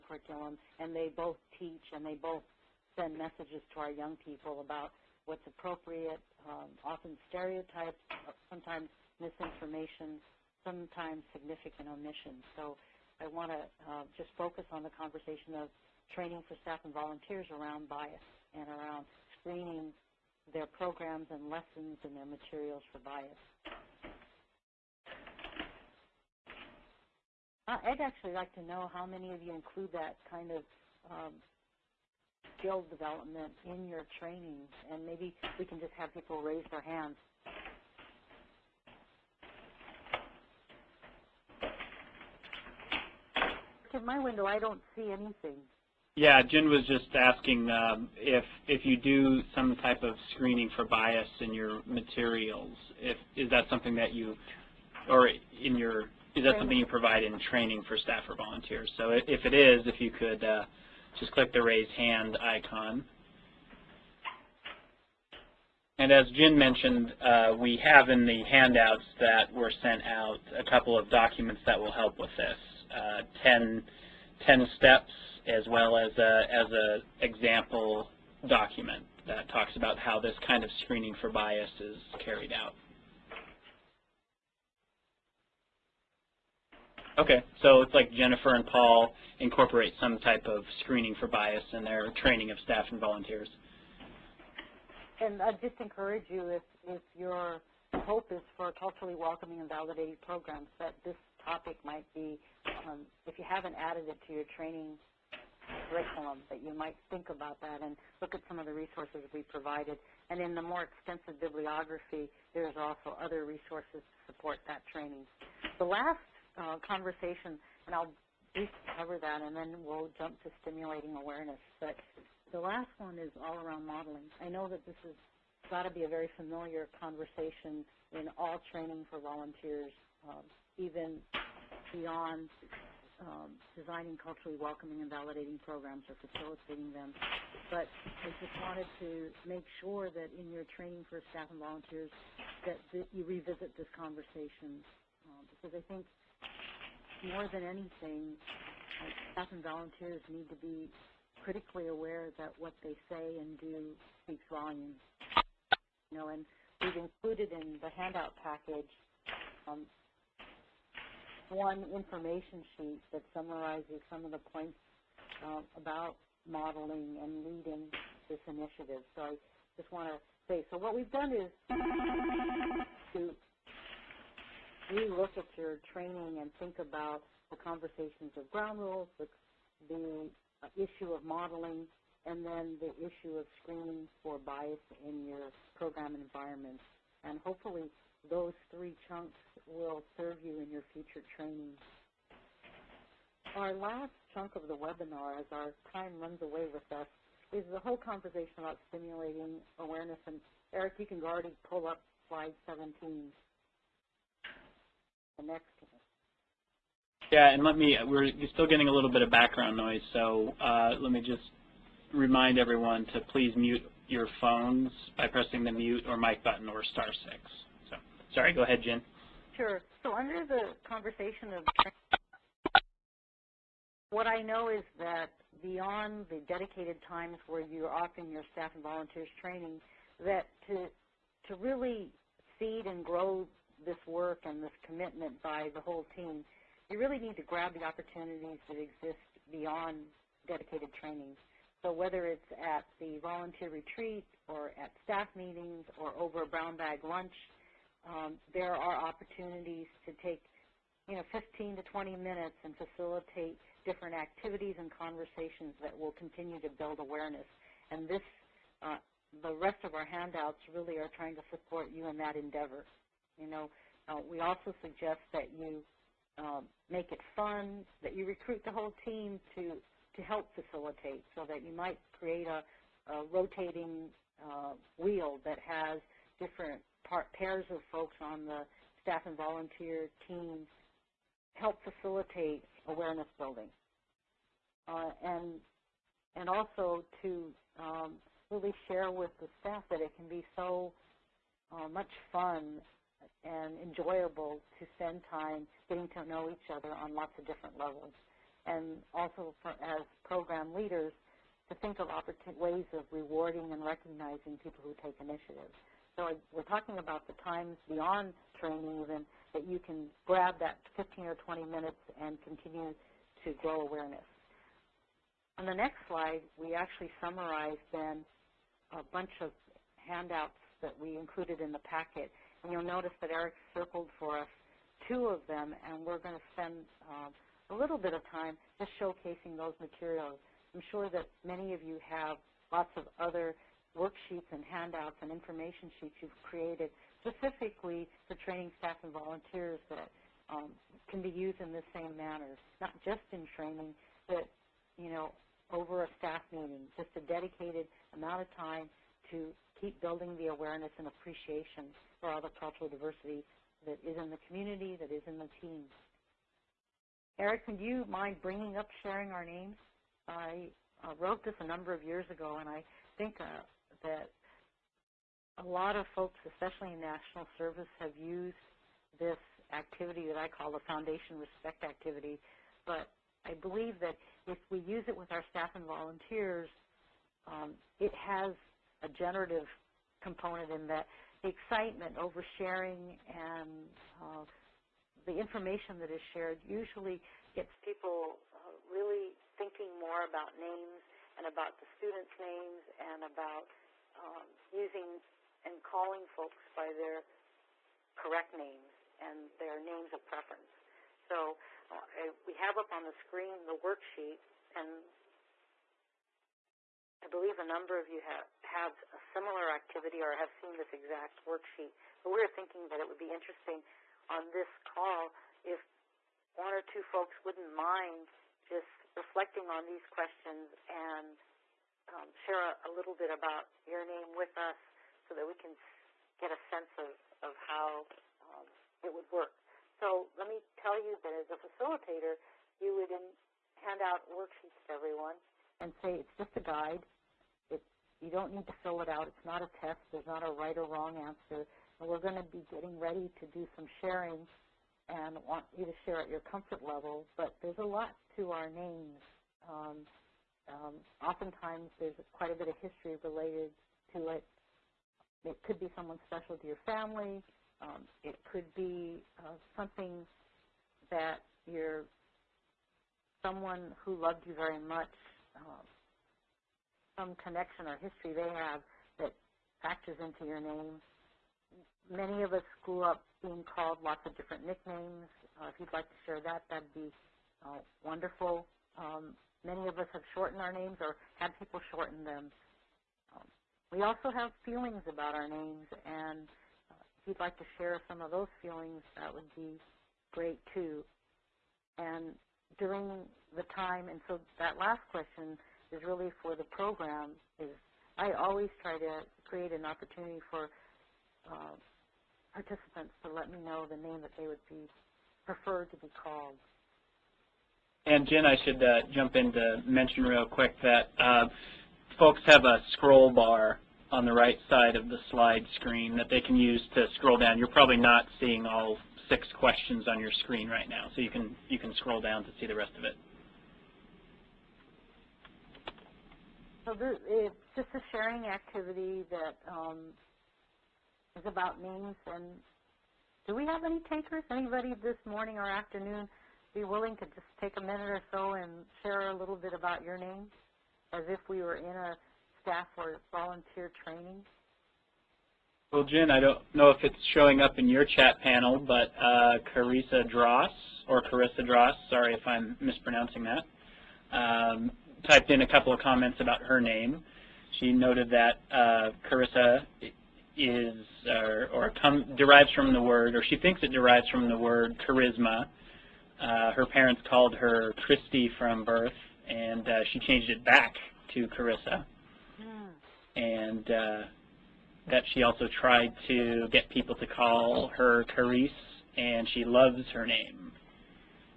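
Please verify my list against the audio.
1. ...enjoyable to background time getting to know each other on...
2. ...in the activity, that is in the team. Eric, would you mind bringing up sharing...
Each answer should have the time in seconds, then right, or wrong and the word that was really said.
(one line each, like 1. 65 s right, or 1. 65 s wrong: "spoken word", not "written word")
1. 293 s wrong: "spend", not "background"
2. 354 s wrong: "community", not "activity".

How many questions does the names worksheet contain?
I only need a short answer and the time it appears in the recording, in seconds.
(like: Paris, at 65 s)
6, at 519 s.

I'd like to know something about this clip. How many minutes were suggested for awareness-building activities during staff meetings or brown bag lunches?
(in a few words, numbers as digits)
15 to 20 minutes.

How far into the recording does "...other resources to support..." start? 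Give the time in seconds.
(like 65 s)
113 s.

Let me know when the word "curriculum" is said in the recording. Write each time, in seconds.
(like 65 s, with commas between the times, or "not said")
0 s, 105 s.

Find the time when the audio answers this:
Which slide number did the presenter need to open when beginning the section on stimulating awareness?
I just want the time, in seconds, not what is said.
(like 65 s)
202 s.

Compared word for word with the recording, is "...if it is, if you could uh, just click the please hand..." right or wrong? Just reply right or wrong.
wrong.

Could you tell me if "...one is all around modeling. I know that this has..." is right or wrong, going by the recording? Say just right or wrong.
right.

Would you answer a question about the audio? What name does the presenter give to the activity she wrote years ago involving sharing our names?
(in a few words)
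foundation respect activity.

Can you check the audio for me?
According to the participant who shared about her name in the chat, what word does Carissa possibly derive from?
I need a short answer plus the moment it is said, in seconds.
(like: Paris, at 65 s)
charisma, at 565 s.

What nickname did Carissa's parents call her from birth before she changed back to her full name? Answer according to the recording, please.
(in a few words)
Christy.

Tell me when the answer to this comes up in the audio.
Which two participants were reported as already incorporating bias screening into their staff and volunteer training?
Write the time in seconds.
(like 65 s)
88 s.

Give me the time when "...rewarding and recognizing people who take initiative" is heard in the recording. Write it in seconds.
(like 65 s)
303 s.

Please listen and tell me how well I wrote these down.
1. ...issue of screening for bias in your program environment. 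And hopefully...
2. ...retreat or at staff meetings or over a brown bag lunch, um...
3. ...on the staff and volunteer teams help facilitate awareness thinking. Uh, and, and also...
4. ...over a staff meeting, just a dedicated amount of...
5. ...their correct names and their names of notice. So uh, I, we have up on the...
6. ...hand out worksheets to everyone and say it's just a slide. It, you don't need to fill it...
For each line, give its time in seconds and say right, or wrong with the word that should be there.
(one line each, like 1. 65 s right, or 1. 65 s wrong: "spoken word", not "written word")
1. 183 s right
2. 243 s right
3. 278 s wrong: "building", not "thinking"
4. 345 s right
5. 396 s wrong: "preference", not "notice"
6. 433 s wrong: "guide", not "slide".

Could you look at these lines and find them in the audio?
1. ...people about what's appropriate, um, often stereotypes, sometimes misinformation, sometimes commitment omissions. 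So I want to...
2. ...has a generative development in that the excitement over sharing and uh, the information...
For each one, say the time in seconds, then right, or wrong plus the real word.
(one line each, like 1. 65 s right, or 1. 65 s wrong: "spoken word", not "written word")
1. 4 s wrong: "significant", not "commitment"
2. 378 s wrong: "component", not "development".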